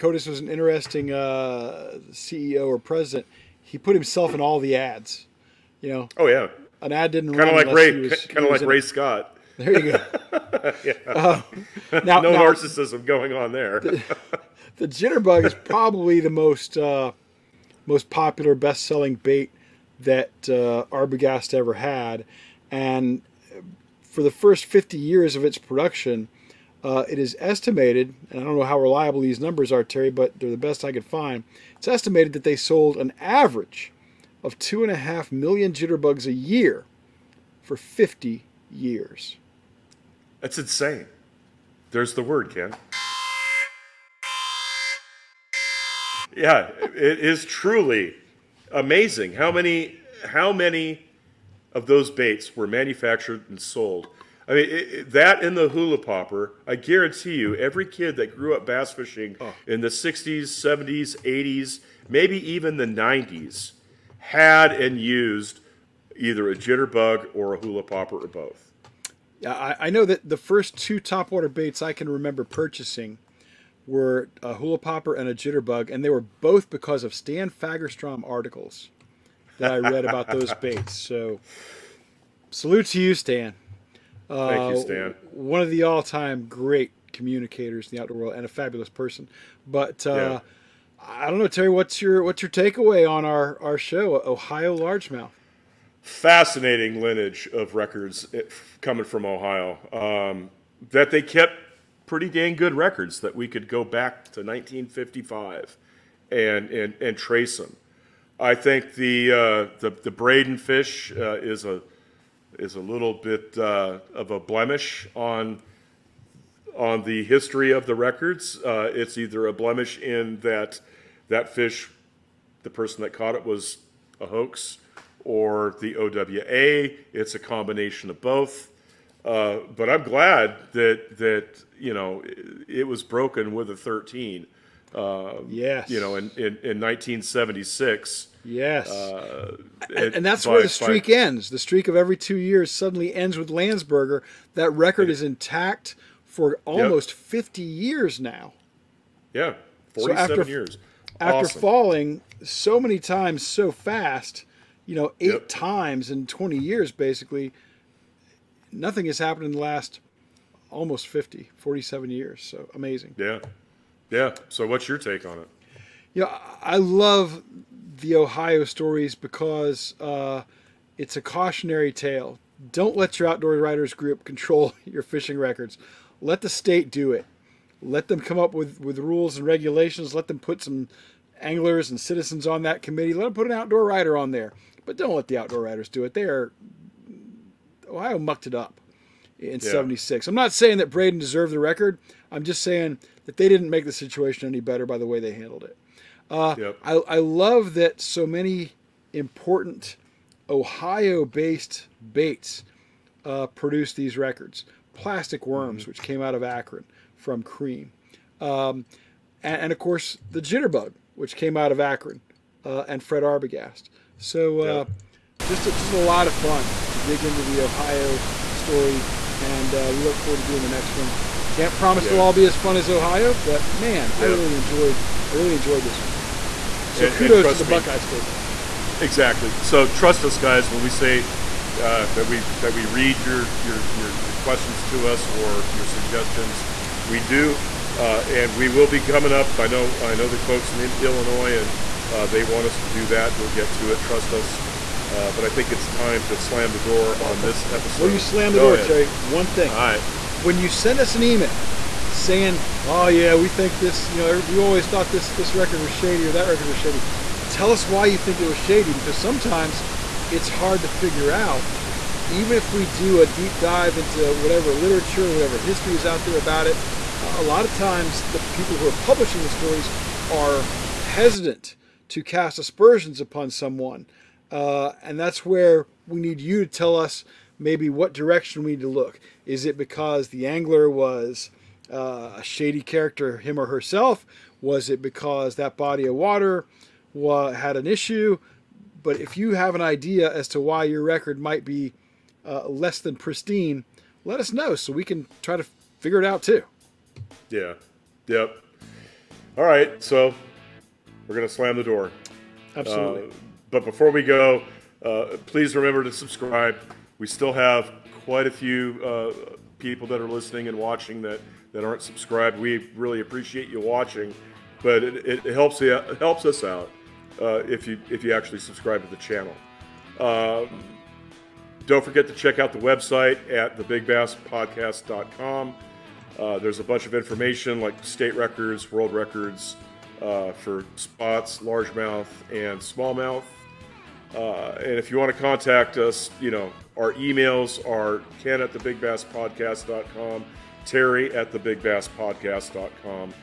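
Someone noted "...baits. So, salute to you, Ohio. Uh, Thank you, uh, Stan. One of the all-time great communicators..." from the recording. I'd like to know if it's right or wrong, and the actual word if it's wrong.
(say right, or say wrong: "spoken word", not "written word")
wrong: "Stan", not "Ohio".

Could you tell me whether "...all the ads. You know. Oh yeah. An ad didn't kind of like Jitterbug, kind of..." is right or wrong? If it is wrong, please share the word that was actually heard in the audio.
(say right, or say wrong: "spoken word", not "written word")
wrong: "Ray", not "Jitterbug".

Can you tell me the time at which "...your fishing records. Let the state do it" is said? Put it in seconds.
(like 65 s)
174 s.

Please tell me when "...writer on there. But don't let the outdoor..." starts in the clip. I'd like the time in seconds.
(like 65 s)
183 s.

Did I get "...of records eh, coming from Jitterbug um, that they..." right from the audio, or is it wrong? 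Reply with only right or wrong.
wrong.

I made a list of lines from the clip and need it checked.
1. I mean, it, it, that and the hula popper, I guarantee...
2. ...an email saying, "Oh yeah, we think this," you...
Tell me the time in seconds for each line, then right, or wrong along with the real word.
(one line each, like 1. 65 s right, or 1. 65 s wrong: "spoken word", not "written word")
1. 54 s right
2. 251 s right.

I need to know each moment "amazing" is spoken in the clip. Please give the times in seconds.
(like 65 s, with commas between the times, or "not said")
48 s, 162 s.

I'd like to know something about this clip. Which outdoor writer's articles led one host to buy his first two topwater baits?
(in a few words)
Stan Fagerstrom.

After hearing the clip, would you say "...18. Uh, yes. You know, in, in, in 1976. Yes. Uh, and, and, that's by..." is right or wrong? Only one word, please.
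wrong.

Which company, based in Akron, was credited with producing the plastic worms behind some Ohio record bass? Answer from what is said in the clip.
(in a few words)
Crème.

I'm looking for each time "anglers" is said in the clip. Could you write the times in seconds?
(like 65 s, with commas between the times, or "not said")
181 s, 280 s.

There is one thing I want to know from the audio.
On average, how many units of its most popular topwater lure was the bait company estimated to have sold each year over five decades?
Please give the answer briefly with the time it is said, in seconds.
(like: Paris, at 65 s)
2.5 million, at 34 s.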